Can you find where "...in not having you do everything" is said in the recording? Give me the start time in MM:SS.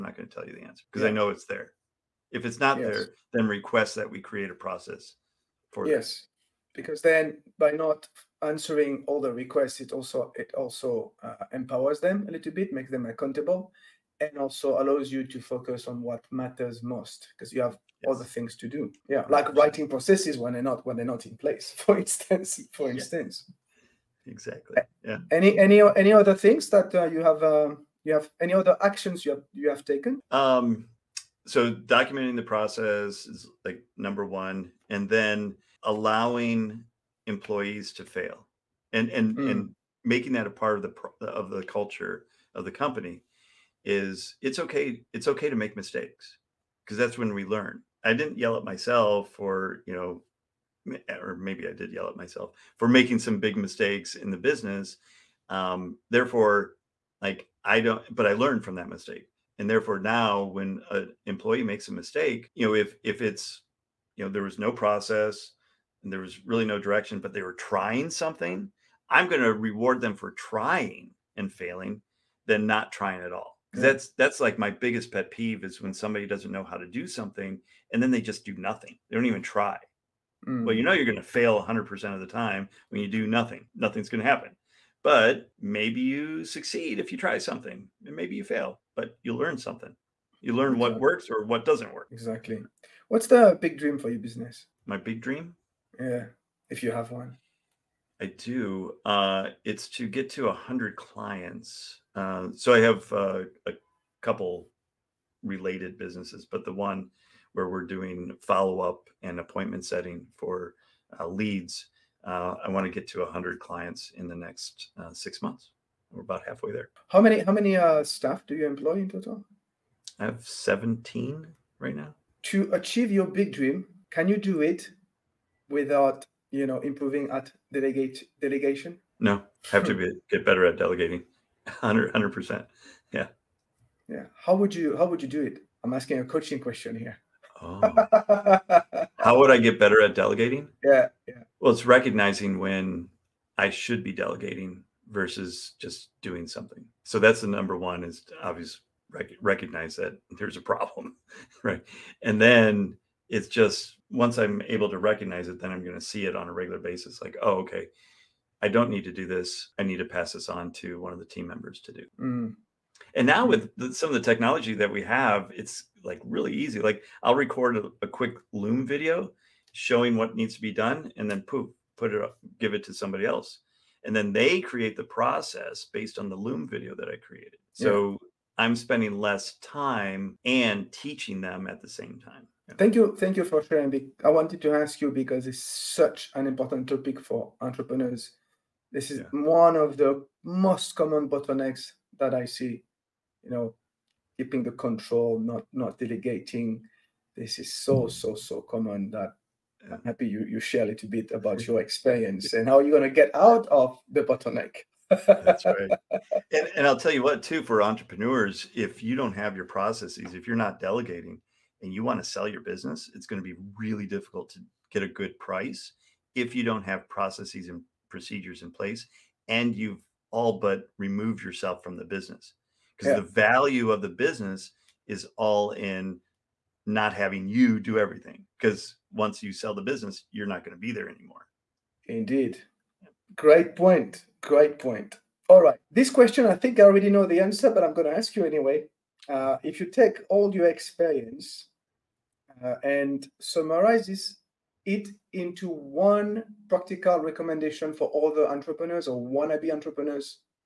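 03:45.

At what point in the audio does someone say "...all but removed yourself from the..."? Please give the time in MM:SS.
03:40.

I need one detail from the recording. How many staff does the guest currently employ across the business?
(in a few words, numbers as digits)
17.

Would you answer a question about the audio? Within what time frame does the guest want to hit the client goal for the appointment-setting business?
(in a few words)
six months.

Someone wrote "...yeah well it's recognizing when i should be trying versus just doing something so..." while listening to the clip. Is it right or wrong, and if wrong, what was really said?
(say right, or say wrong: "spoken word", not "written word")
wrong: "delegating", not "trying".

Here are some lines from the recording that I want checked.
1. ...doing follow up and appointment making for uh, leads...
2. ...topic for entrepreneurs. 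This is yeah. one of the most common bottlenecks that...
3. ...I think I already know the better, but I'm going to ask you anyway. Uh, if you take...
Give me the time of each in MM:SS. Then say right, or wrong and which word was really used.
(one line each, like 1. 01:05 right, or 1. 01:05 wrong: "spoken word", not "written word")
1. 01:47 wrong: "setting", not "making"
2. 03:06 right
3. 03:56 wrong: "answer", not "better".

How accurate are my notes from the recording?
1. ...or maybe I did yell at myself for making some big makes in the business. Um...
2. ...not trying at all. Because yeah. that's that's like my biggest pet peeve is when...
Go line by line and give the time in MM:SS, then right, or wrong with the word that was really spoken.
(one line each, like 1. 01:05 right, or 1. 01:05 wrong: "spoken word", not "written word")
1. 00:51 wrong: "mistakes", not "makes"
2. 01:12 right.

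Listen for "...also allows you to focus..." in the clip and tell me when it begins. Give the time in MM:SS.
00:14.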